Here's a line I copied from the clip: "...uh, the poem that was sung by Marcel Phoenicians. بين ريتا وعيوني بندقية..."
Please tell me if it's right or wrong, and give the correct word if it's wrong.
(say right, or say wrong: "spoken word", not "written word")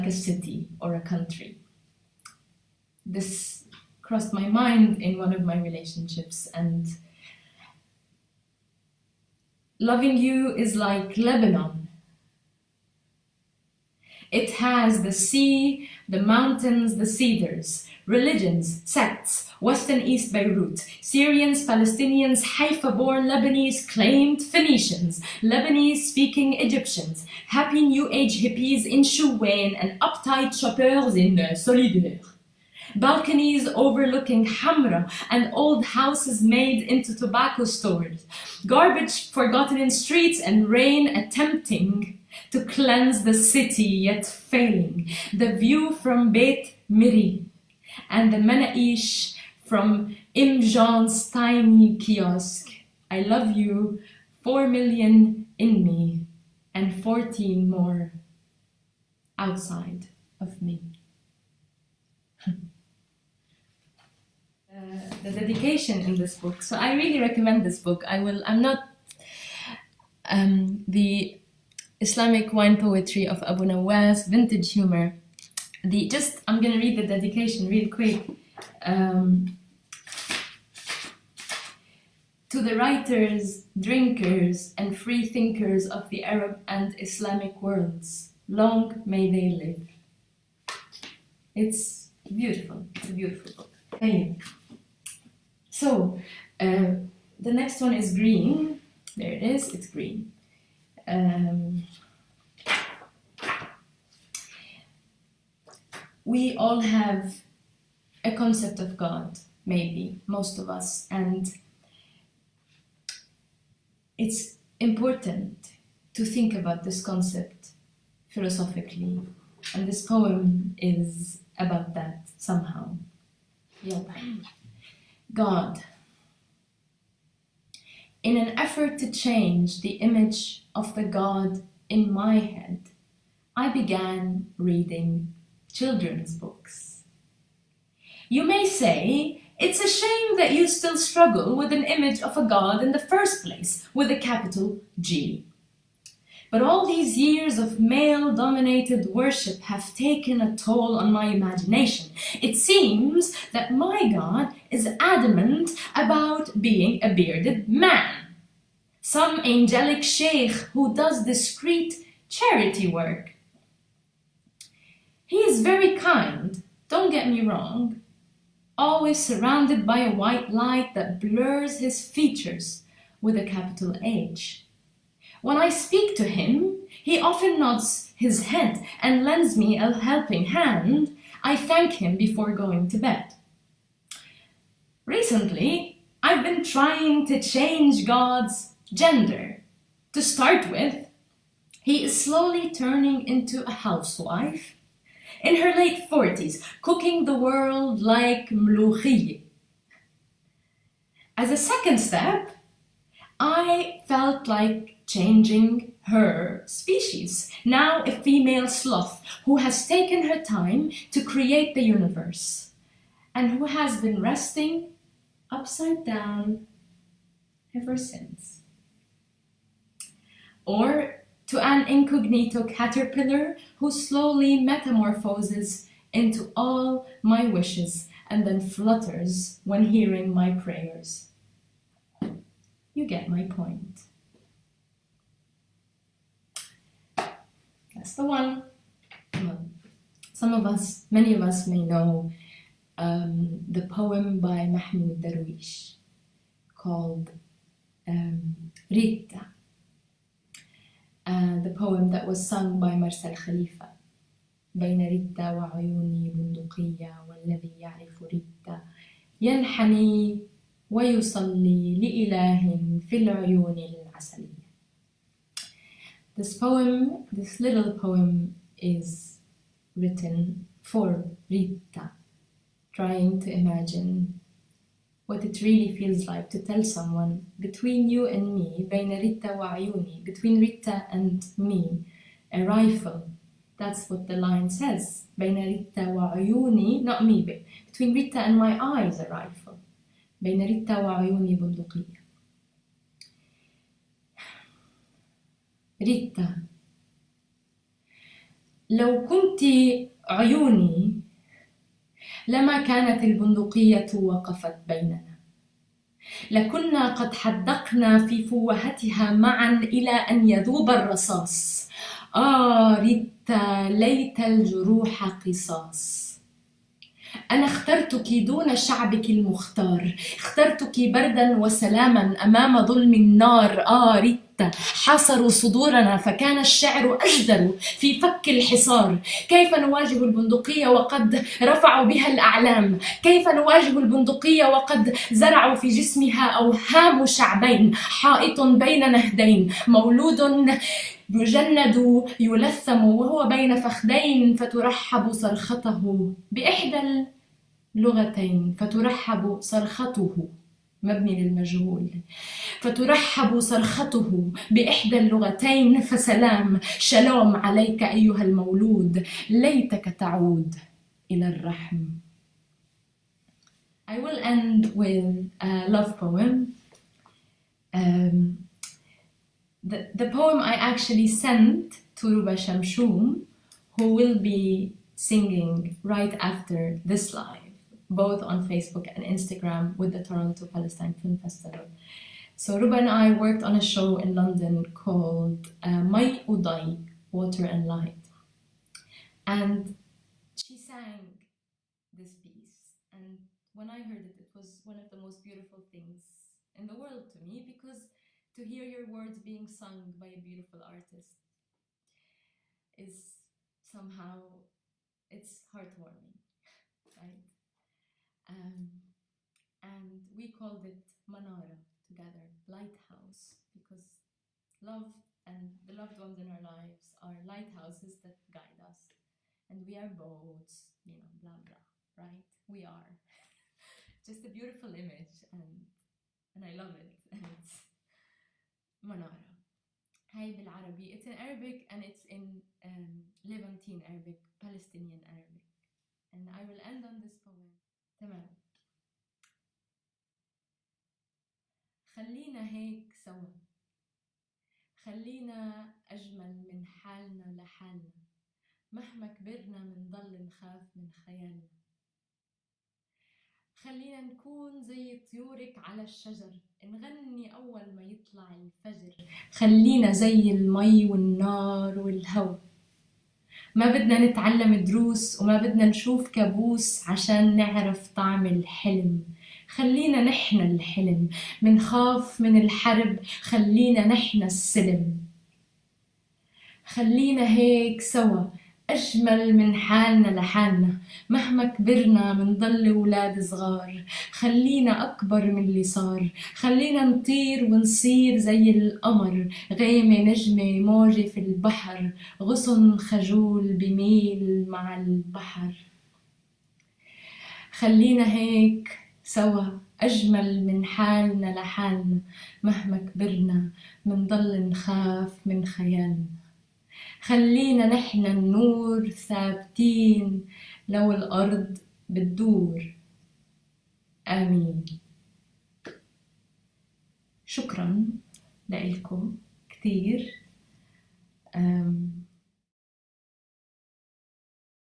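wrong: "Khalifa", not "Phoenicians".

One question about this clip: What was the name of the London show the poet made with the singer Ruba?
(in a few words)
Mai Udai.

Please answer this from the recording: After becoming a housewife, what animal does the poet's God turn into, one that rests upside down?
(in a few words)
sloth.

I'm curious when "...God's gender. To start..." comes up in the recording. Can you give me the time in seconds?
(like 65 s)
188 s.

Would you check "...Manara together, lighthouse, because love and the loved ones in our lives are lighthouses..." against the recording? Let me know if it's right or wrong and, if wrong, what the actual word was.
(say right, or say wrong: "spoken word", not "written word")
right.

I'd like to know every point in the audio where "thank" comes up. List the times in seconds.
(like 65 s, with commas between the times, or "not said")
93 s, 181 s.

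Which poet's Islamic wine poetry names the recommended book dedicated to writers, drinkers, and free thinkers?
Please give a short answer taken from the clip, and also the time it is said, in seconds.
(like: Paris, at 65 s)
Abu Nawas, at 73 s.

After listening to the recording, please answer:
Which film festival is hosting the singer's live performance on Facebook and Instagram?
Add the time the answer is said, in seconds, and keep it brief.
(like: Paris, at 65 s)
Toronto Palestine Film Festival, at 380 s.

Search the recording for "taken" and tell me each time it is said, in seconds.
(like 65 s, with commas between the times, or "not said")
149 s, 209 s.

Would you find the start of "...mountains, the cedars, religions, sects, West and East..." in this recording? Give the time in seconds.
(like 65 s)
16 s.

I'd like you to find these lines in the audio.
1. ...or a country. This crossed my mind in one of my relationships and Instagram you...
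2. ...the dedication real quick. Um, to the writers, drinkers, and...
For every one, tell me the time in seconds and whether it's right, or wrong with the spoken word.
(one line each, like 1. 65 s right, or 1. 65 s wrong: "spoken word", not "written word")
1. 0 s wrong: "Loving", not "Instagram"
2. 76 s right.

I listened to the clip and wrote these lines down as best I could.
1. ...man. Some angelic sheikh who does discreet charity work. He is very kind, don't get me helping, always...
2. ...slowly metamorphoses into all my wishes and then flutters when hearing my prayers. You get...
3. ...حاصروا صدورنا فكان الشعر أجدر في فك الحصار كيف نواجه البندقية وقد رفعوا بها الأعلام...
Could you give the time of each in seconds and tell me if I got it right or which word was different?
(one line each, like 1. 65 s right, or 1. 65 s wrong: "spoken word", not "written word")
1. 157 s wrong: "wrong", not "helping"
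2. 223 s right
3. 325 s right.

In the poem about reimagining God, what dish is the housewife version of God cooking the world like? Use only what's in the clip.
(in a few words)
mlouchi.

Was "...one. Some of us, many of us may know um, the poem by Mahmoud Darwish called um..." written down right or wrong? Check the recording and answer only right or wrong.
right.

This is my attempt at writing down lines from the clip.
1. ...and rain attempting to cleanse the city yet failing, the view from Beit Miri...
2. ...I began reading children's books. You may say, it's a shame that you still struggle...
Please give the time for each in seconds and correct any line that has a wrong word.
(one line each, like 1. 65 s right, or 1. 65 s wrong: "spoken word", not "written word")
1. 40 s right
2. 133 s right.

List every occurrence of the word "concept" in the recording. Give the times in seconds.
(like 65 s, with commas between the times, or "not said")
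108 s, 117 s.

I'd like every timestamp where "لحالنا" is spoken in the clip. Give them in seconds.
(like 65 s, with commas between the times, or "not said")
447 s, 480 s, 501 s.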